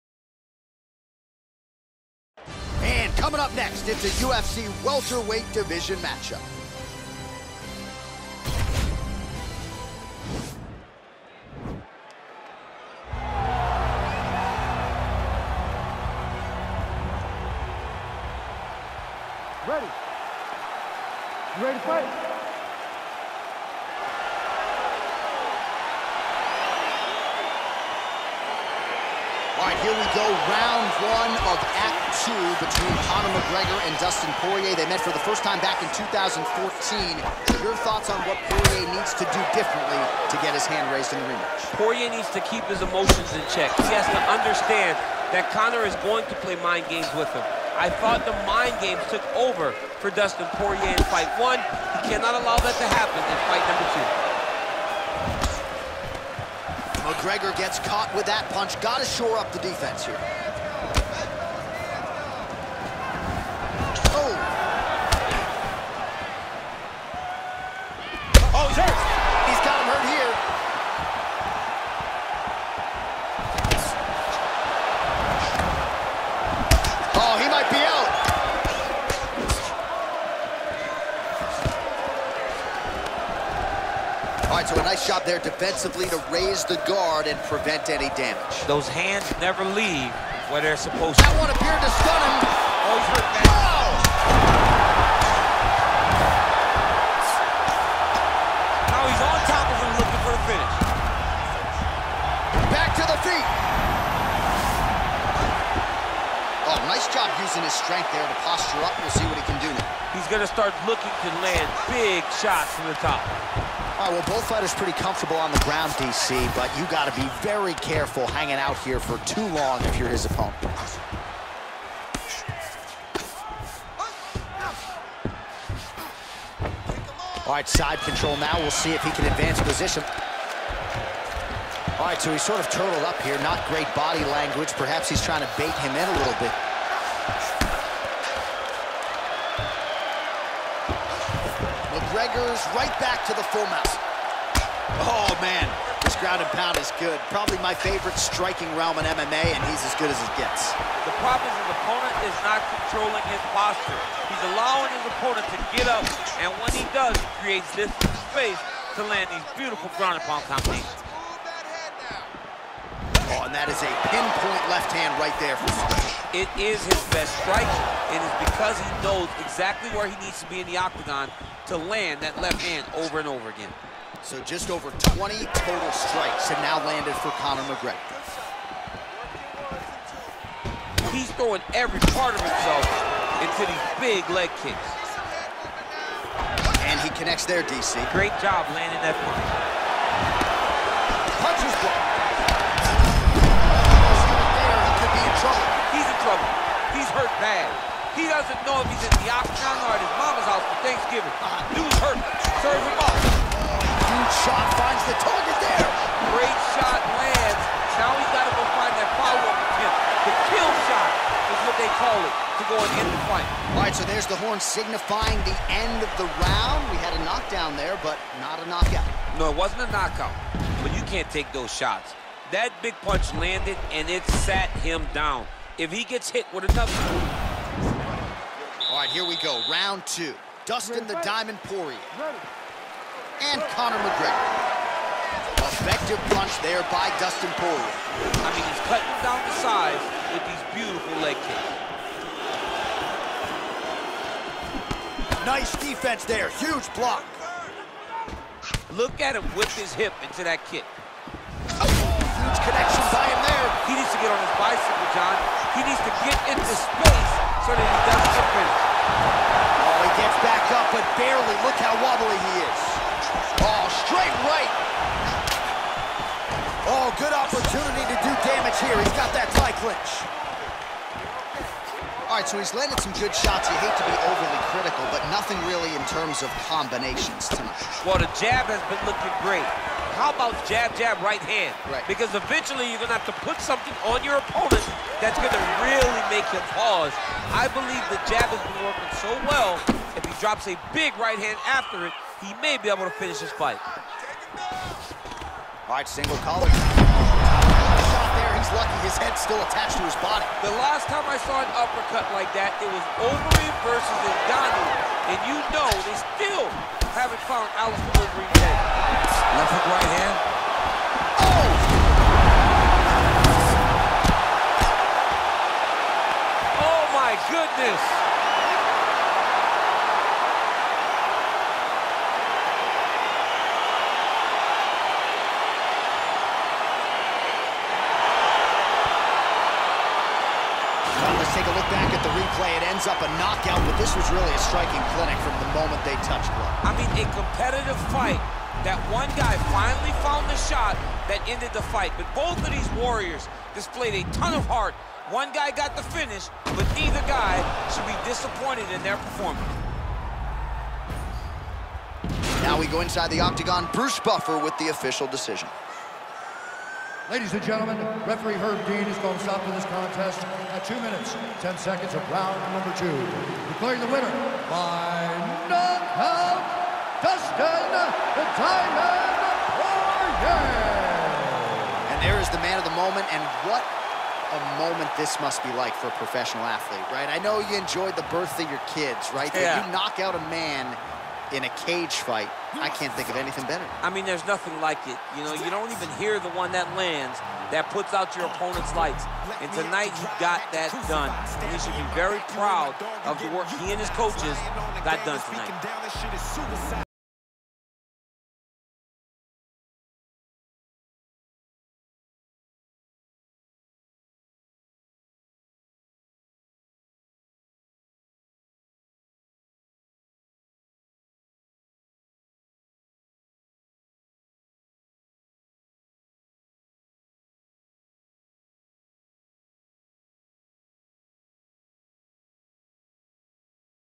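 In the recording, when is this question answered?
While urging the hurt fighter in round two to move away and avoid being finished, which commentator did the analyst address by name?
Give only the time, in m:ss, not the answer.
4:15.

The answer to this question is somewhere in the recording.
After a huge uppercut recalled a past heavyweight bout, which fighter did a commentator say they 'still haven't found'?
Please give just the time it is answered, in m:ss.
5:07.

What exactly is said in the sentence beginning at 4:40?
How about jab, jab, right hand?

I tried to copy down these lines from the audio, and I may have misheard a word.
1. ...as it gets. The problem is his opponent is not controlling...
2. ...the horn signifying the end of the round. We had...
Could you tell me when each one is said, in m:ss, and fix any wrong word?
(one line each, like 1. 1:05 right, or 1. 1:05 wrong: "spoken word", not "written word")
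1. 2:30 right
2. 3:34 right.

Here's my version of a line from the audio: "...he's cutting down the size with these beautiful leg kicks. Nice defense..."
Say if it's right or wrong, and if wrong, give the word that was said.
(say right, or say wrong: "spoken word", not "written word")
right.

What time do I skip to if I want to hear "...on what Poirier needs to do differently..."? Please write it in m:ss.
0:38.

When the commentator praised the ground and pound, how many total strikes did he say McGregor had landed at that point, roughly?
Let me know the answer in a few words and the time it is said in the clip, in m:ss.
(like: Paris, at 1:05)
just over 20, at 2:54.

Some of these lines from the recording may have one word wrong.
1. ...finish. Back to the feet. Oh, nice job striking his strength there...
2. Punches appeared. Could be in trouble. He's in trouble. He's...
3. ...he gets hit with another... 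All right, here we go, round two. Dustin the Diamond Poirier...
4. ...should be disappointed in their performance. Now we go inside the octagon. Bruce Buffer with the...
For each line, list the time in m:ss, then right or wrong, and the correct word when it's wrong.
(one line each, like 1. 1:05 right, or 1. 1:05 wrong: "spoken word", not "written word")
1. 1:40 wrong: "using", not "striking"
2. 3:11 wrong: "blocked", not "appeared"
3. 3:45 right
4. 5:47 right.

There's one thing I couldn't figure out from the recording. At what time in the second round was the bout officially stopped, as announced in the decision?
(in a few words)
2:10.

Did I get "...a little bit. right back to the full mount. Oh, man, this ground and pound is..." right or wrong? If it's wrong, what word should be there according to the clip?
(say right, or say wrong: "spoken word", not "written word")
right.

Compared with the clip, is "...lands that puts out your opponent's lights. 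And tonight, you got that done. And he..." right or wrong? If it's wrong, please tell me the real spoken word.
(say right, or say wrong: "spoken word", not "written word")
right.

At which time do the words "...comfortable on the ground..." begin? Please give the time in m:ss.
1:54.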